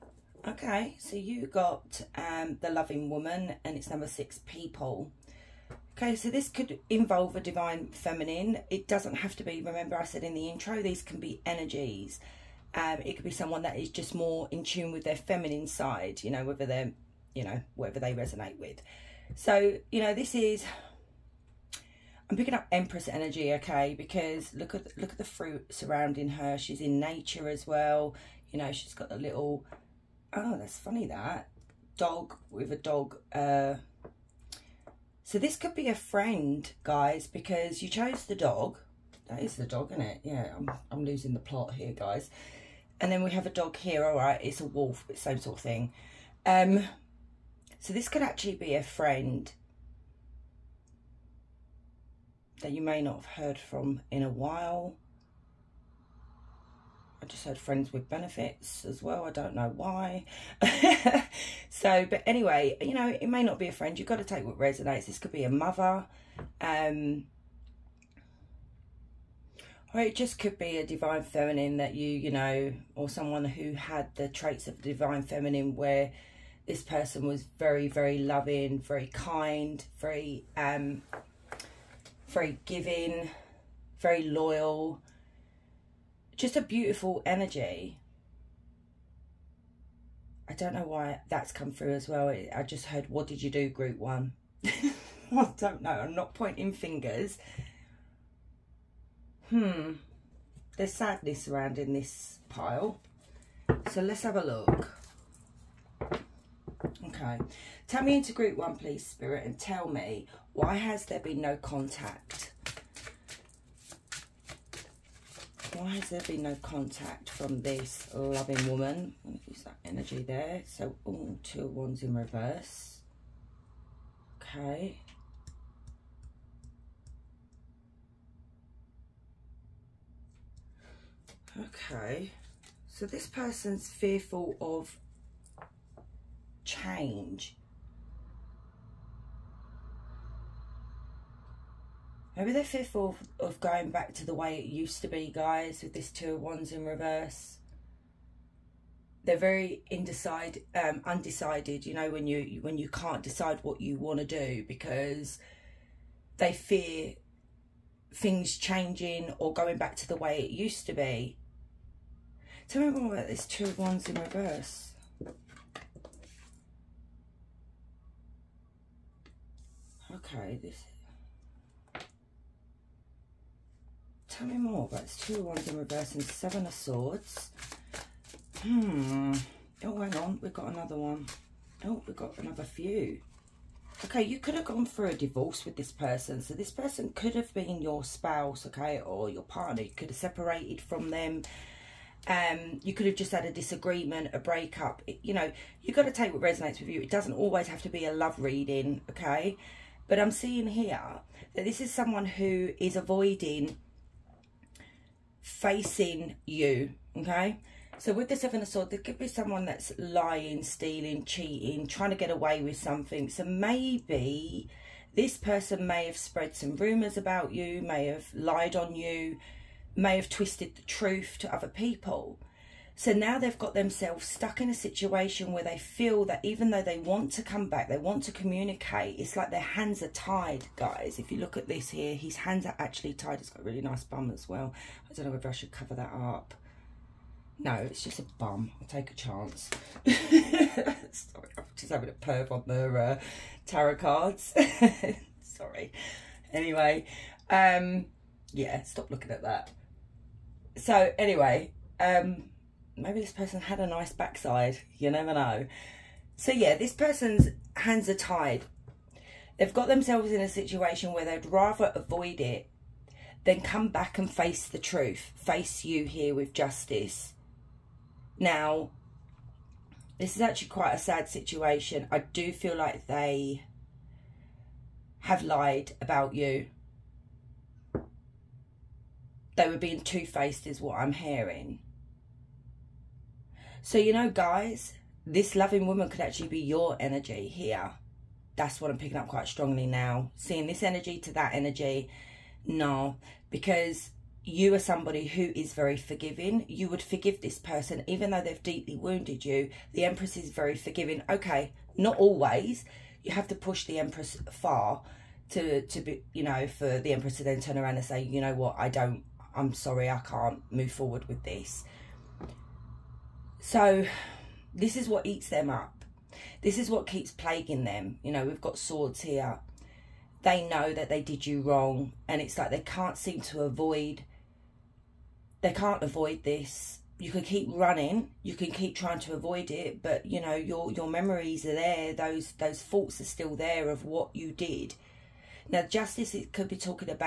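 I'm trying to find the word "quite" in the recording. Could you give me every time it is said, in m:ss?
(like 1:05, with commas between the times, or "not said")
4:30, 4:49.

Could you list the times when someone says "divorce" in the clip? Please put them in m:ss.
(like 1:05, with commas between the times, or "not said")
3:05.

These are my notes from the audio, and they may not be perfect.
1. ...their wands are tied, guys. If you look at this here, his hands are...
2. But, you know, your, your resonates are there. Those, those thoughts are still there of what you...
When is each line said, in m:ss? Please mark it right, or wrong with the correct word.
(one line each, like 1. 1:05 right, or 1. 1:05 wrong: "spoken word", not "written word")
1. 3:49 wrong: "hands", not "wands"
2. 5:30 wrong: "memories", not "resonates".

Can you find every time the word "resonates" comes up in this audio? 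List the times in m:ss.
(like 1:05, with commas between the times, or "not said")
0:18, 1:04, 3:16.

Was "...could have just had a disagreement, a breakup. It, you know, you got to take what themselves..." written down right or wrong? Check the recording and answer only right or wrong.
wrong.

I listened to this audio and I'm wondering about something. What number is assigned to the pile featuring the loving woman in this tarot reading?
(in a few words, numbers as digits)
6.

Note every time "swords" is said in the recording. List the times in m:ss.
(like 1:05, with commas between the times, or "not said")
2:56, 3:28, 5:18.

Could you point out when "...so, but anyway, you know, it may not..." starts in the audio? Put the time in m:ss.
1:01.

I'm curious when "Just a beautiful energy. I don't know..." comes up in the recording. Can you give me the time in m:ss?
1:26.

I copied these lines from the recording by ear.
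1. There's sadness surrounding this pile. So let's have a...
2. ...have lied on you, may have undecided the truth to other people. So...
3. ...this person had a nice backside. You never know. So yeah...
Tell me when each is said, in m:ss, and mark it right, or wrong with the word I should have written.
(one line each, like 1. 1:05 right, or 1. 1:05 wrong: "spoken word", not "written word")
1. 1:40 right
2. 3:38 wrong: "twisted", not "undecided"
3. 4:13 right.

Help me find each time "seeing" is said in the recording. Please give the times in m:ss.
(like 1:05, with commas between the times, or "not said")
3:20, 4:50.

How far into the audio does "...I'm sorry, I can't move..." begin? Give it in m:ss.
5:09.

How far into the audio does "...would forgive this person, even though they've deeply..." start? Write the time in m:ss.
4:56.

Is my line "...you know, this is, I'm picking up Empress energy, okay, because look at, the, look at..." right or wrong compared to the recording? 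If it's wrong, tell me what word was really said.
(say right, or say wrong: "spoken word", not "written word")
right.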